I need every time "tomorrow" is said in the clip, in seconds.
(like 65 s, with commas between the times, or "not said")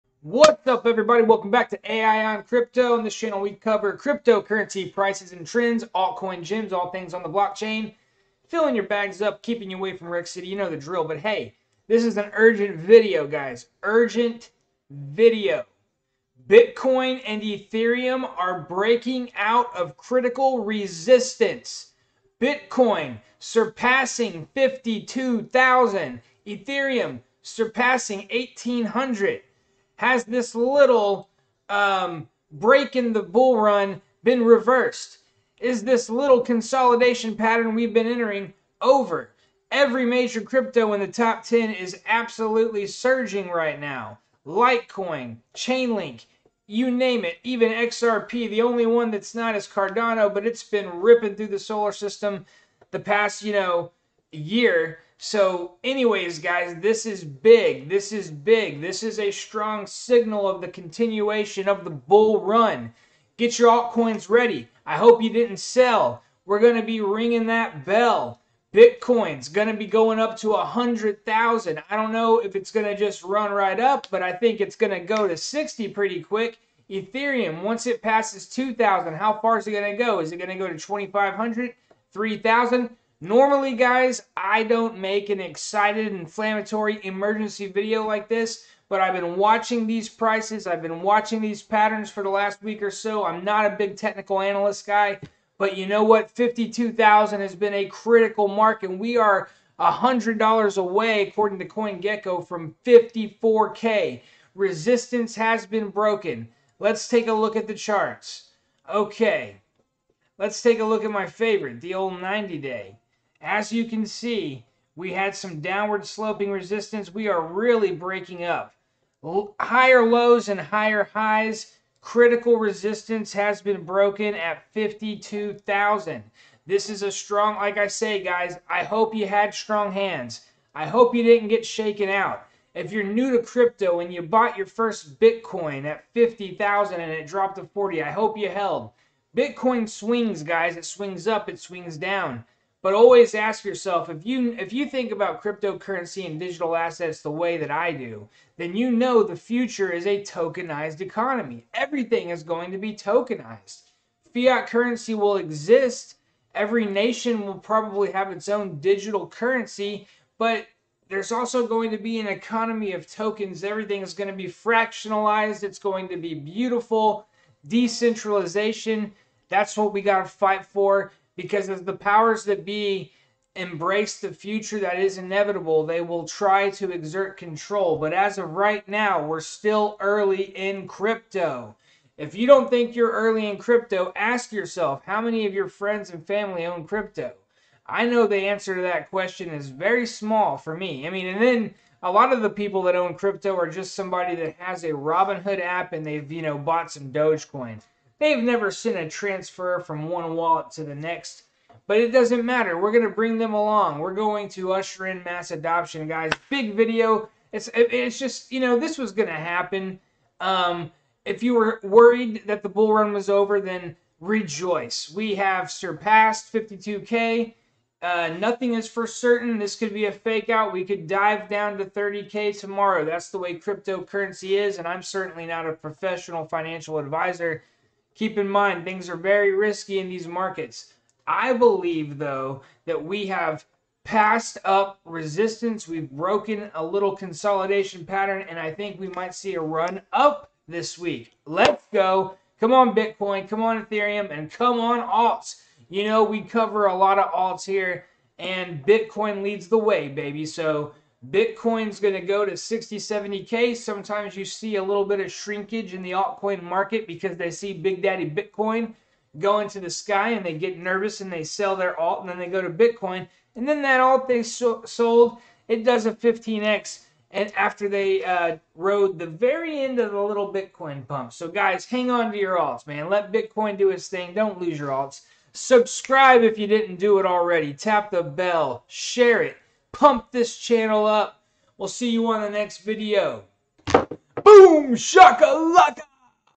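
222 s.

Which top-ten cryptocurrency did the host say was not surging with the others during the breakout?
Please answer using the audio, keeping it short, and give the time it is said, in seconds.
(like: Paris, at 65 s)
Cardano, at 49 s.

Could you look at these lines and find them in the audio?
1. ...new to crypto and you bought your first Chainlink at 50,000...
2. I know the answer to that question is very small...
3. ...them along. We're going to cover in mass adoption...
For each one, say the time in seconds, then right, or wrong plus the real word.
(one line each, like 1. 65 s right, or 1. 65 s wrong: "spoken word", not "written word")
1. 133 s wrong: "Bitcoin", not "Chainlink"
2. 187 s right
3. 203 s wrong: "usher", not "cover".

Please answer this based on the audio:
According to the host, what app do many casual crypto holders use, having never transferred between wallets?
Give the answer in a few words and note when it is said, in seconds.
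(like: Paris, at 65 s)
Robinhood, at 194 s.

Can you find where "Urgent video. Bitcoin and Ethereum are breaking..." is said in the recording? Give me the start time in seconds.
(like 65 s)
13 s.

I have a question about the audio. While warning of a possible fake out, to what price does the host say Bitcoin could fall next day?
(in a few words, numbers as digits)
30K.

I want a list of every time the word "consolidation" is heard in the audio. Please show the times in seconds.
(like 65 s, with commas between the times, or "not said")
36 s, 237 s.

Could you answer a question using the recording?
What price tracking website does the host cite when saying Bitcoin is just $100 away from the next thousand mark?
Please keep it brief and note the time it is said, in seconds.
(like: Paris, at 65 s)
CoinGecko, at 101 s.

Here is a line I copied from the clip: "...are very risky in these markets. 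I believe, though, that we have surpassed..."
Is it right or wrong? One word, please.
wrong.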